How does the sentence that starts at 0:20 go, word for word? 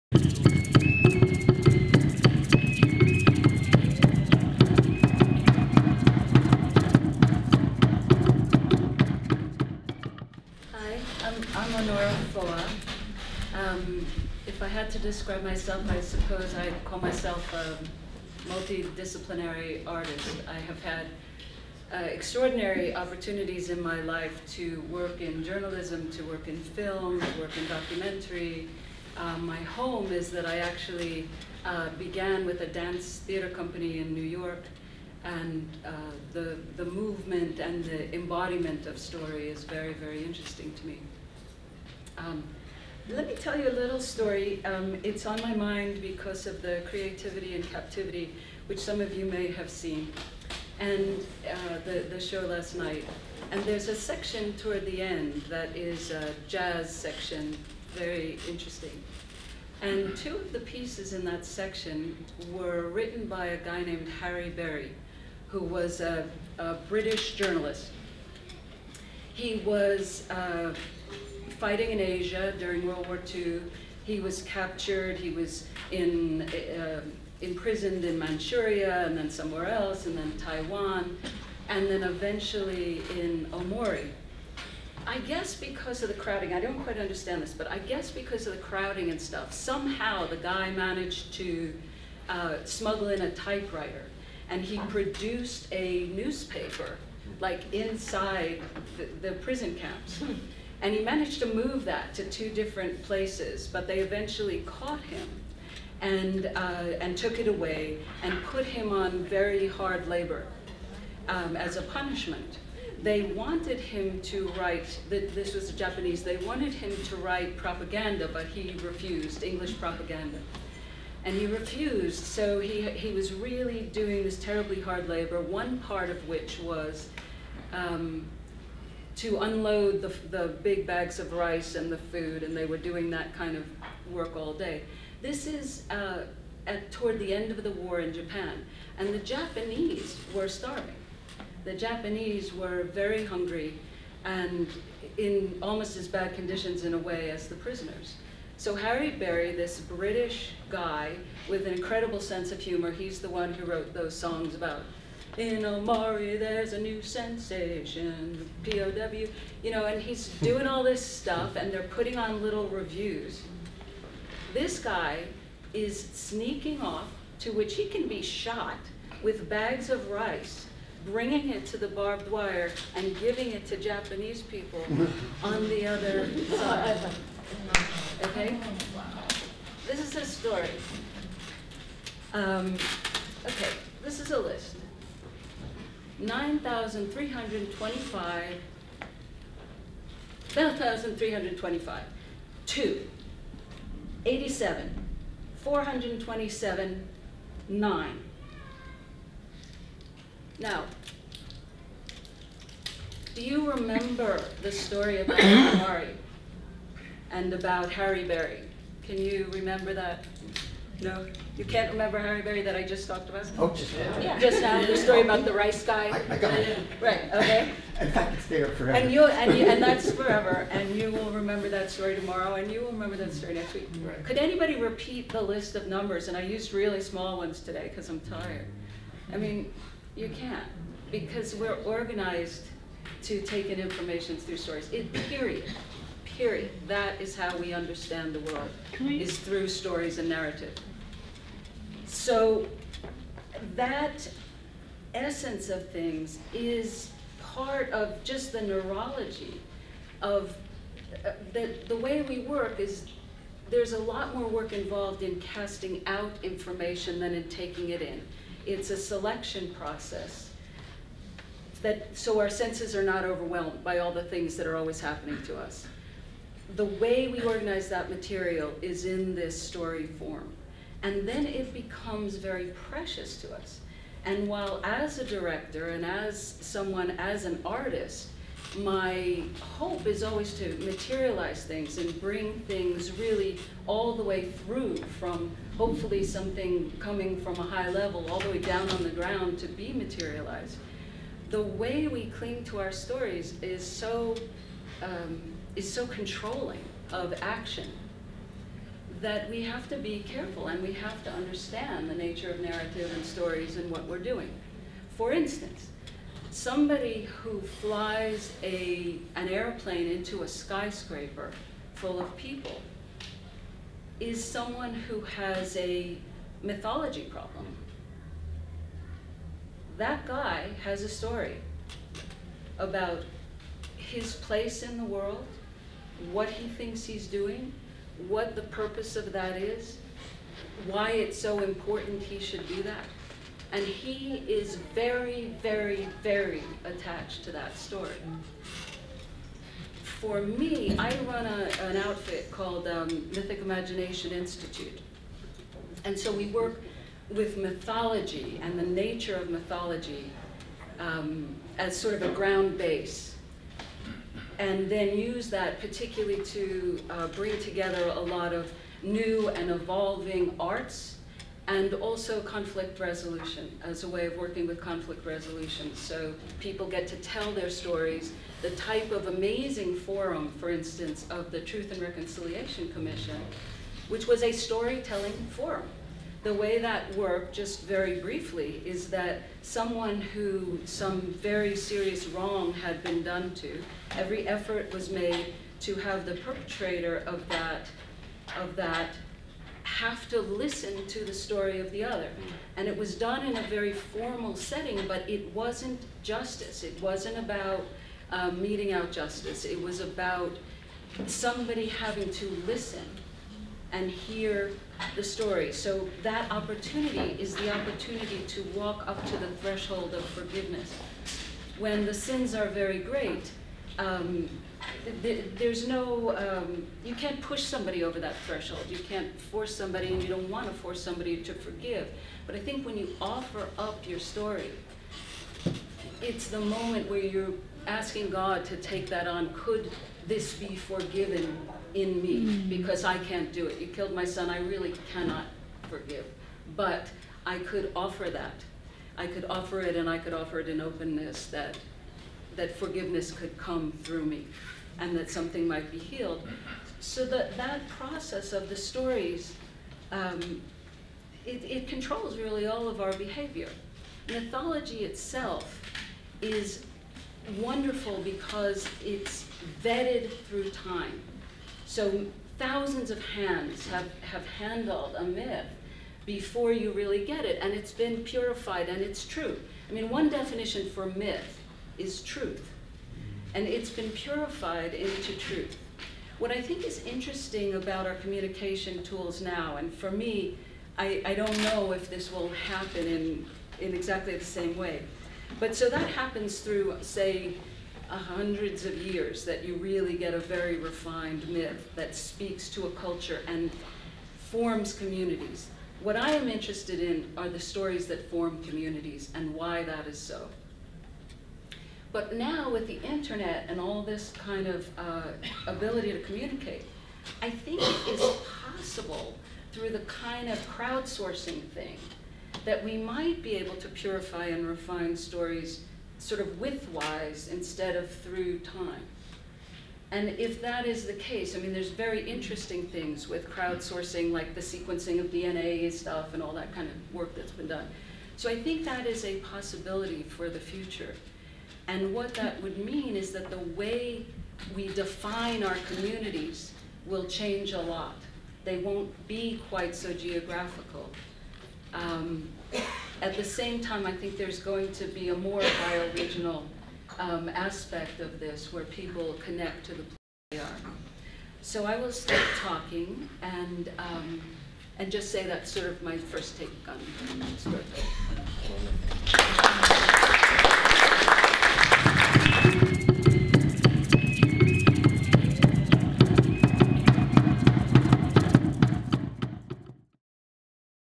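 I have had uh, extraordinary opportunities in my life to work in journalism, to work in film, to work in documentary.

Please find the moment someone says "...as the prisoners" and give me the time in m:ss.
2:27.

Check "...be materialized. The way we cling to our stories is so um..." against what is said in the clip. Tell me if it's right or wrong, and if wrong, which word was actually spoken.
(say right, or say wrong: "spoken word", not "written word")
right.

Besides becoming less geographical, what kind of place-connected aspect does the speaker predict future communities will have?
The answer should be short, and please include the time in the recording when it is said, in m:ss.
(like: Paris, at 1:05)
bioregional, at 9:05.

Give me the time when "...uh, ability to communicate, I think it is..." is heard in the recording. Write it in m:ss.
8:24.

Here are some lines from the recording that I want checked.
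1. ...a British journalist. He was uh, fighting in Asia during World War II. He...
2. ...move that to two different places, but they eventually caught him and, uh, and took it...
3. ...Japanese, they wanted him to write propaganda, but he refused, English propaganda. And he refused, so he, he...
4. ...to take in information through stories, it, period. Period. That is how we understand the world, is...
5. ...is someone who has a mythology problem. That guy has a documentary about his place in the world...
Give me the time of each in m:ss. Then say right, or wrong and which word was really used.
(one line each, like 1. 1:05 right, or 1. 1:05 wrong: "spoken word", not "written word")
1. 1:06 right
2. 1:41 right
3. 1:55 right
4. 3:53 right
5. 5:14 wrong: "story", not "documentary".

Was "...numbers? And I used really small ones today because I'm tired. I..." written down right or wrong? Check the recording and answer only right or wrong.
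right.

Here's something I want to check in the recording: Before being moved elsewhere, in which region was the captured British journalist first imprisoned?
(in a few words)
Manchuria.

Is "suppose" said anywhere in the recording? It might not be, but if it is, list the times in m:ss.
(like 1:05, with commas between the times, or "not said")
0:16.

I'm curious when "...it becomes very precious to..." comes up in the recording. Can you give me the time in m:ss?
4:31.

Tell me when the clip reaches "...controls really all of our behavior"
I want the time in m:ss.
7:31.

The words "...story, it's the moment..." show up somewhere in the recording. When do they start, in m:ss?
7:04.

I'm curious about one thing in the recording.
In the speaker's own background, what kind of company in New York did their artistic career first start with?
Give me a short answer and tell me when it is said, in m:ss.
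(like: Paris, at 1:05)
dance theater company, at 0:32.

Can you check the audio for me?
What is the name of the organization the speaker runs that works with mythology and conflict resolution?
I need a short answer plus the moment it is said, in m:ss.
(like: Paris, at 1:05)
Mythic Imagination Institute, at 5:43.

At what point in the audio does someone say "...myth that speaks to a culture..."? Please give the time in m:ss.
8:11.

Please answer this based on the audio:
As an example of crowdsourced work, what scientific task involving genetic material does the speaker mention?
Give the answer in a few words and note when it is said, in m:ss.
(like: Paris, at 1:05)
sequencing of DNA, at 8:44.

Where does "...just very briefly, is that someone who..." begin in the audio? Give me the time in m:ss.
6:17.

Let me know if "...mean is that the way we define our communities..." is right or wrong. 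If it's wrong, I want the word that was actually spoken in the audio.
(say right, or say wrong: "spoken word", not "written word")
right.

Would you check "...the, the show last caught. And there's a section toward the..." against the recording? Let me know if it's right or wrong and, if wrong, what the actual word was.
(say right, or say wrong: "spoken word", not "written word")
wrong: "night", not "caught".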